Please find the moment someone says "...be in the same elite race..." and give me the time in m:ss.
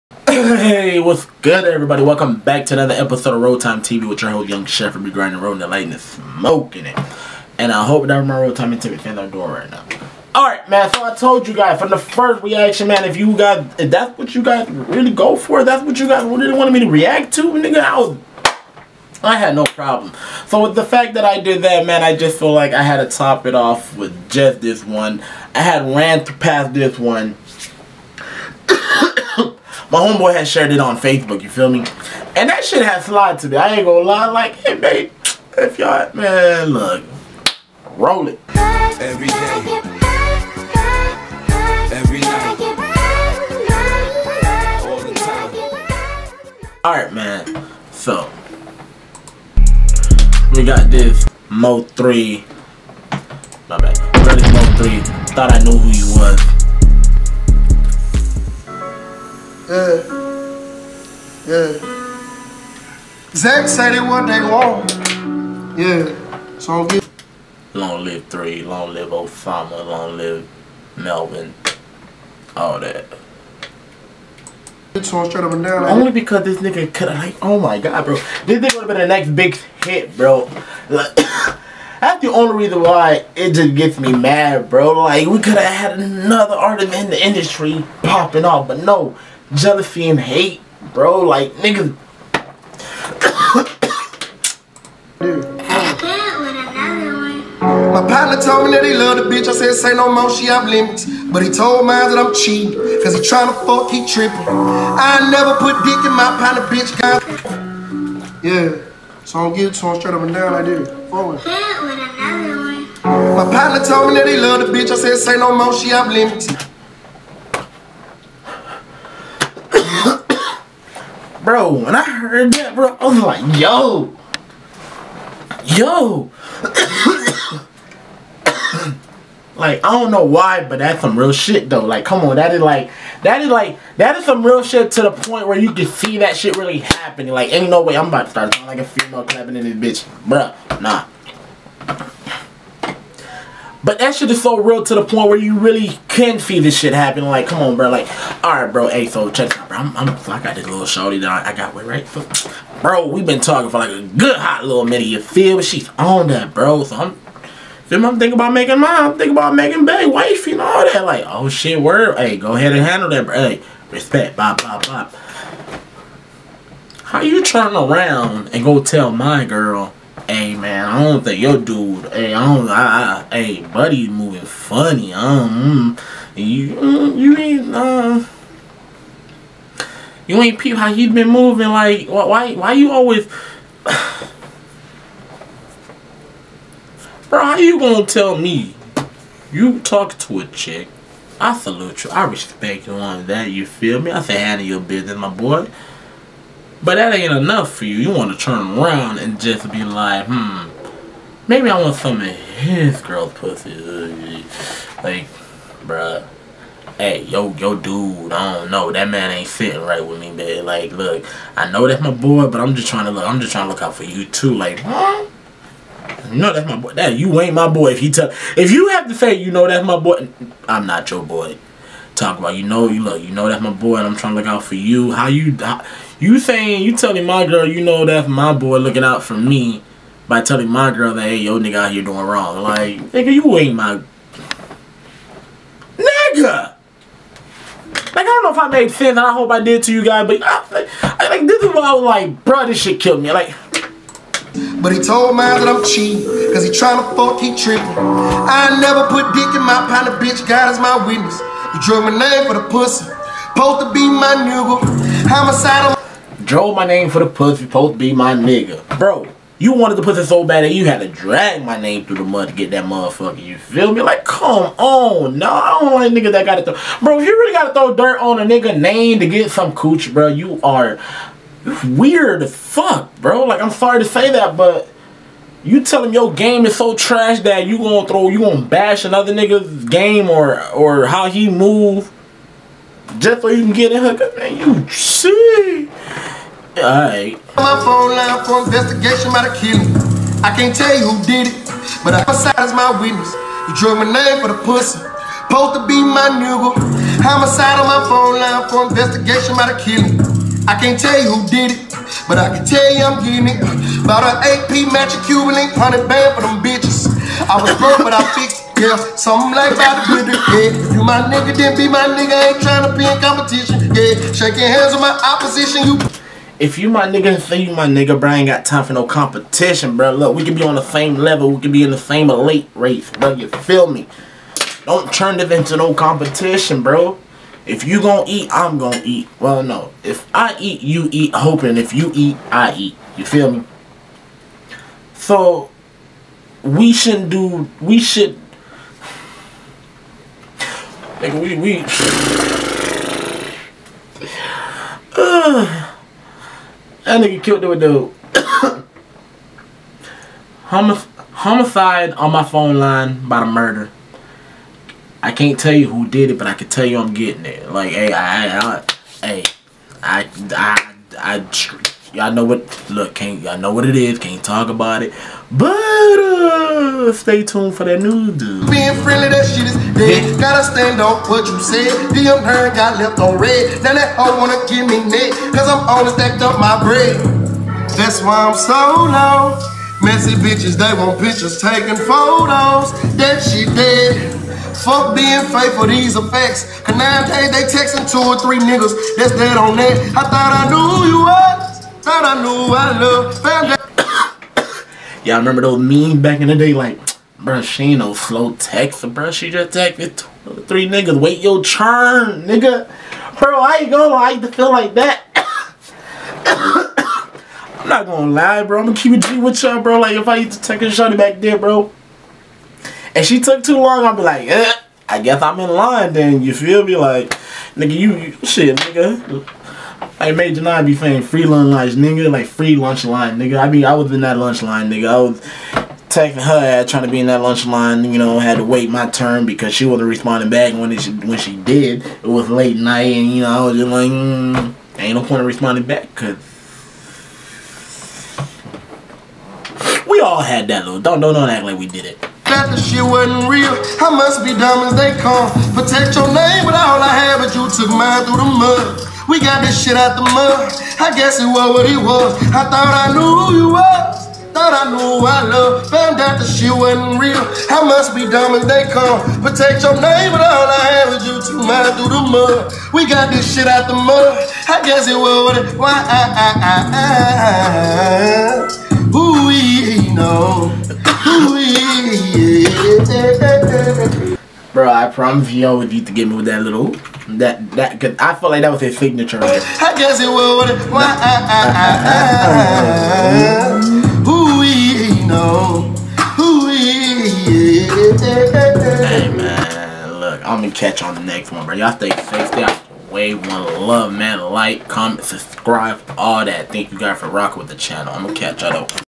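5:21.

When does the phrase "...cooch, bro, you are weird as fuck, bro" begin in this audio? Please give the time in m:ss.
4:29.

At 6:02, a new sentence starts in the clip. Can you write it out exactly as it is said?
Look, can't y'all know what it is?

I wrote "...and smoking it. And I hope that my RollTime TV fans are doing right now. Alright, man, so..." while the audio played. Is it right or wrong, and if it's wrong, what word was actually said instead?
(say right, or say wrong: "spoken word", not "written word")
right.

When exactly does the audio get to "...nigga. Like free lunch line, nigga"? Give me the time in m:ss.
7:01.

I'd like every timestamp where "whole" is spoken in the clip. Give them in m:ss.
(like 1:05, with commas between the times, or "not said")
0:04.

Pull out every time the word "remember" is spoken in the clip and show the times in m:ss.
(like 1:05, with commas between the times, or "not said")
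6:35.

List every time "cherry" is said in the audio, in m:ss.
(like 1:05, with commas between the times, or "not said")
not said.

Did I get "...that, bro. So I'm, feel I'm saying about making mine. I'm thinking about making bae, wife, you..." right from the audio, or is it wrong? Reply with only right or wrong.
wrong.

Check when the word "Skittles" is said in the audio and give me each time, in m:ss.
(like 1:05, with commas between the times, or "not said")
not said.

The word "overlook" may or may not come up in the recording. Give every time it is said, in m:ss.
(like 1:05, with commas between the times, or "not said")
not said.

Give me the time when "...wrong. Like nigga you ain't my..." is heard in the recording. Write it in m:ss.
3:52.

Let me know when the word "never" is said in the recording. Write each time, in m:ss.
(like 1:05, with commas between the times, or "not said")
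1:45, 4:08.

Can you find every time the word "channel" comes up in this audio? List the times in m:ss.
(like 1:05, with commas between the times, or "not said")
8:17.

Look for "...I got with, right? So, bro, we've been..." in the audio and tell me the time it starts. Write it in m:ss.
2:31.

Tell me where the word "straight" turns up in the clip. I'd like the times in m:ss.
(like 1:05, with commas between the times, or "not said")
1:15, 1:49.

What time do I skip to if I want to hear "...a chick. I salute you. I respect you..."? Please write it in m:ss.
3:10.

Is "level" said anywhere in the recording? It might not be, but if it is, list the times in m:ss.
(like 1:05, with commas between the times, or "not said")
5:21.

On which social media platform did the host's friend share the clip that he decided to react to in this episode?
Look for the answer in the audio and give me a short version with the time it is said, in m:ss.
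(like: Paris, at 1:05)
Facebook, at 0:30.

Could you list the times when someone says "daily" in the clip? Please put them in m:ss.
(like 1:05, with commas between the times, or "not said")
not said.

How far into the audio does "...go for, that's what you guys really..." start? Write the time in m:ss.
0:15.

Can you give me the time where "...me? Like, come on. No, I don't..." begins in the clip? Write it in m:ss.
4:23.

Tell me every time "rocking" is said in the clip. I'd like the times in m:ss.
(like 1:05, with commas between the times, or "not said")
8:17.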